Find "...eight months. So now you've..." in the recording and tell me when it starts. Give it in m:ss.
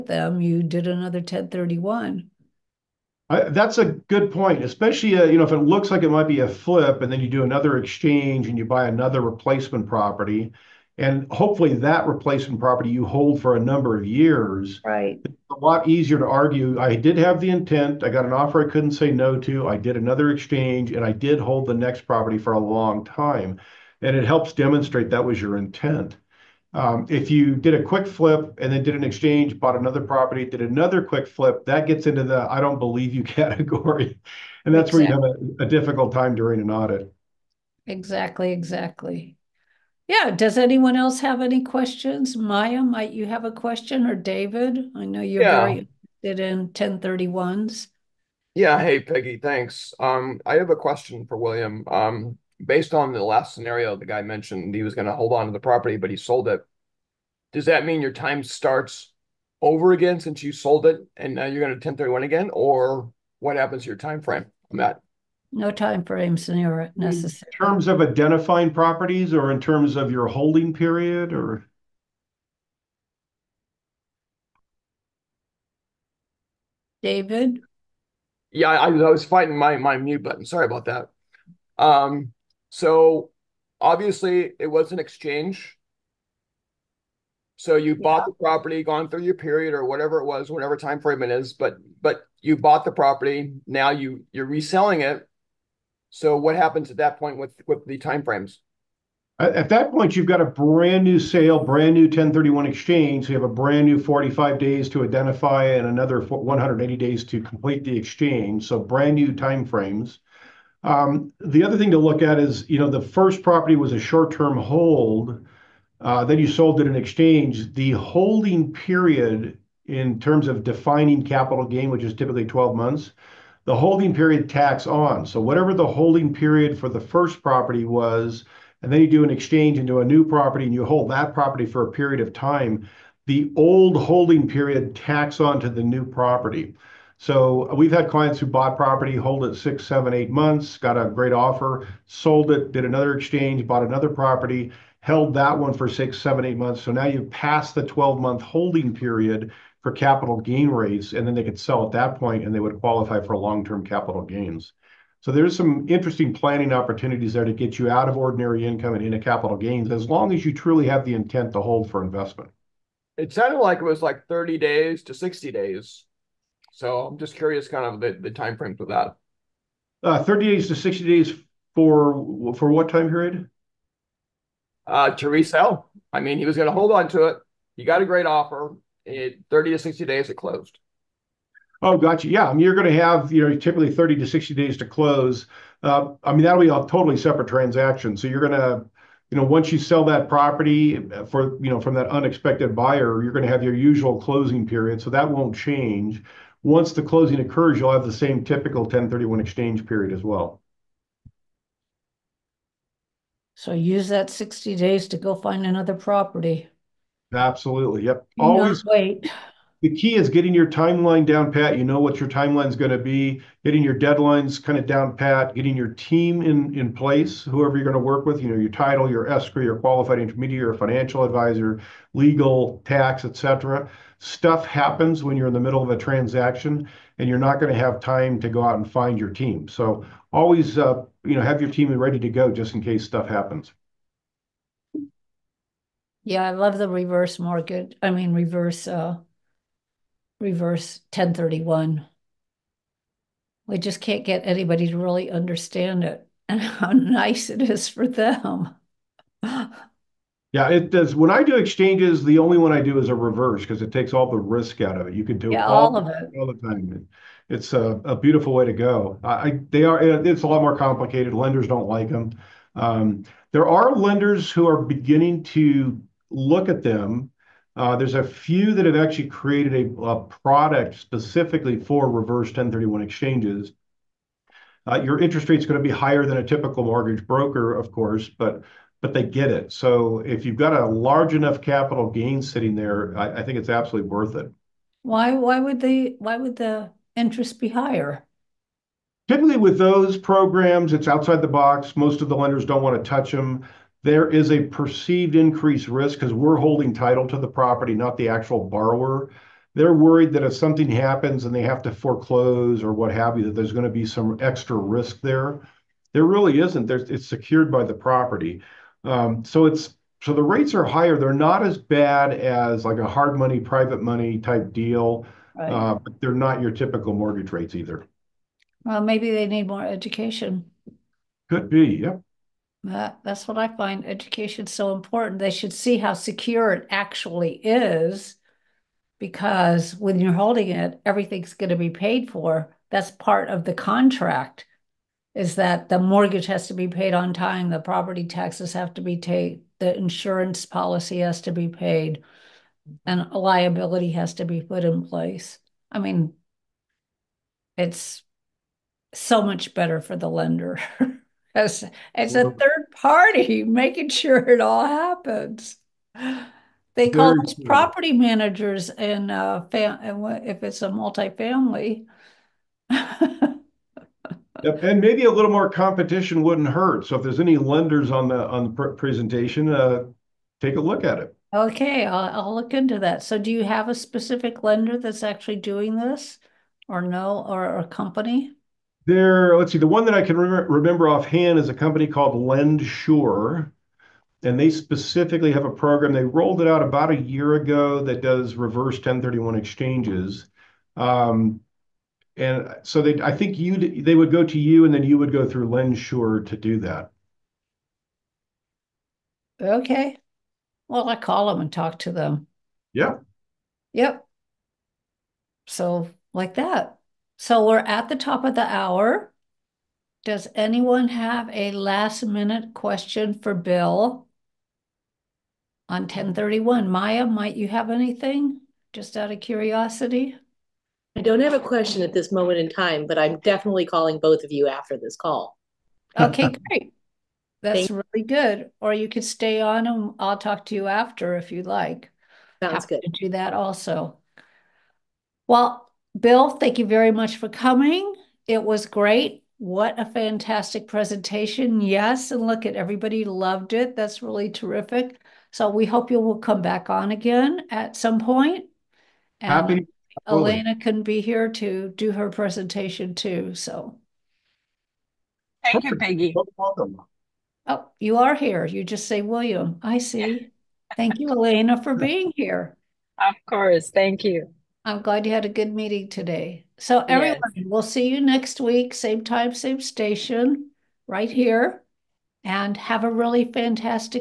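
2:26.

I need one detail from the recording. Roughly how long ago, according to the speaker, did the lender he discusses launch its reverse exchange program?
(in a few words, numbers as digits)
About a year ago.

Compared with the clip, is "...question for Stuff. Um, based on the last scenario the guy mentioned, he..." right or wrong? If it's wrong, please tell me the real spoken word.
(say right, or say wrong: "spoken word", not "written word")
wrong: "William", not "Stuff".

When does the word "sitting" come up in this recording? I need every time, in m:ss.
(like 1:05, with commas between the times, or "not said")
4:42.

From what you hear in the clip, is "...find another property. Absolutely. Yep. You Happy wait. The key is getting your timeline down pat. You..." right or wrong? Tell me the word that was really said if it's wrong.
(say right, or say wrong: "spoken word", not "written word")
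wrong: "Always", not "Happy".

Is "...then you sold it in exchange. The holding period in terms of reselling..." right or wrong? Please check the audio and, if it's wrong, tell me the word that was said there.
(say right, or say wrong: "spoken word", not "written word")
wrong: "defining", not "reselling".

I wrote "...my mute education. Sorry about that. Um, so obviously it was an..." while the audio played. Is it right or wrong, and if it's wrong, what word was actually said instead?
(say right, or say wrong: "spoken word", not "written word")
wrong: "button", not "education".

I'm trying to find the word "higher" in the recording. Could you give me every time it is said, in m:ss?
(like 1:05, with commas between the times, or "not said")
4:35, 4:47, 5:10.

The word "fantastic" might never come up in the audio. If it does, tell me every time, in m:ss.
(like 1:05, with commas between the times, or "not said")
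7:20, 7:53.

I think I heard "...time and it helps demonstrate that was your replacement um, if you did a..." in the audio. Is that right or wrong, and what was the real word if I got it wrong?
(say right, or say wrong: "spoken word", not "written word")
wrong: "intent", not "replacement".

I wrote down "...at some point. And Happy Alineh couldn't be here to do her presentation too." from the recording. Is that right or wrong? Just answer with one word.
right.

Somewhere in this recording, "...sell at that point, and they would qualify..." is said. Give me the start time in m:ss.
2:31.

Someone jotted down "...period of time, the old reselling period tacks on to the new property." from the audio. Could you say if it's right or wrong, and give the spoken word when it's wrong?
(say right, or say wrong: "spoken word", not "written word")
wrong: "holding", not "reselling".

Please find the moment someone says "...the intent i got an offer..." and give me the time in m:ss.
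0:17.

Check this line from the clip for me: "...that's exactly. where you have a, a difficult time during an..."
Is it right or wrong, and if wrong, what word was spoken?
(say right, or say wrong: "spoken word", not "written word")
right.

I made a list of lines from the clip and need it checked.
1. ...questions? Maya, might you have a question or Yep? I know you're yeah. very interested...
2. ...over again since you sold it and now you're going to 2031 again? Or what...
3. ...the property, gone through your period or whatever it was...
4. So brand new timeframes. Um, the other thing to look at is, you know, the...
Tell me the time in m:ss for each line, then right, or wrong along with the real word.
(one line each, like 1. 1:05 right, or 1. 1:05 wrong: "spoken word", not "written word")
1. 0:41 wrong: "David", not "Yep"
2. 0:59 wrong: "1031", not "2031"
3. 1:28 right
4. 1:48 right.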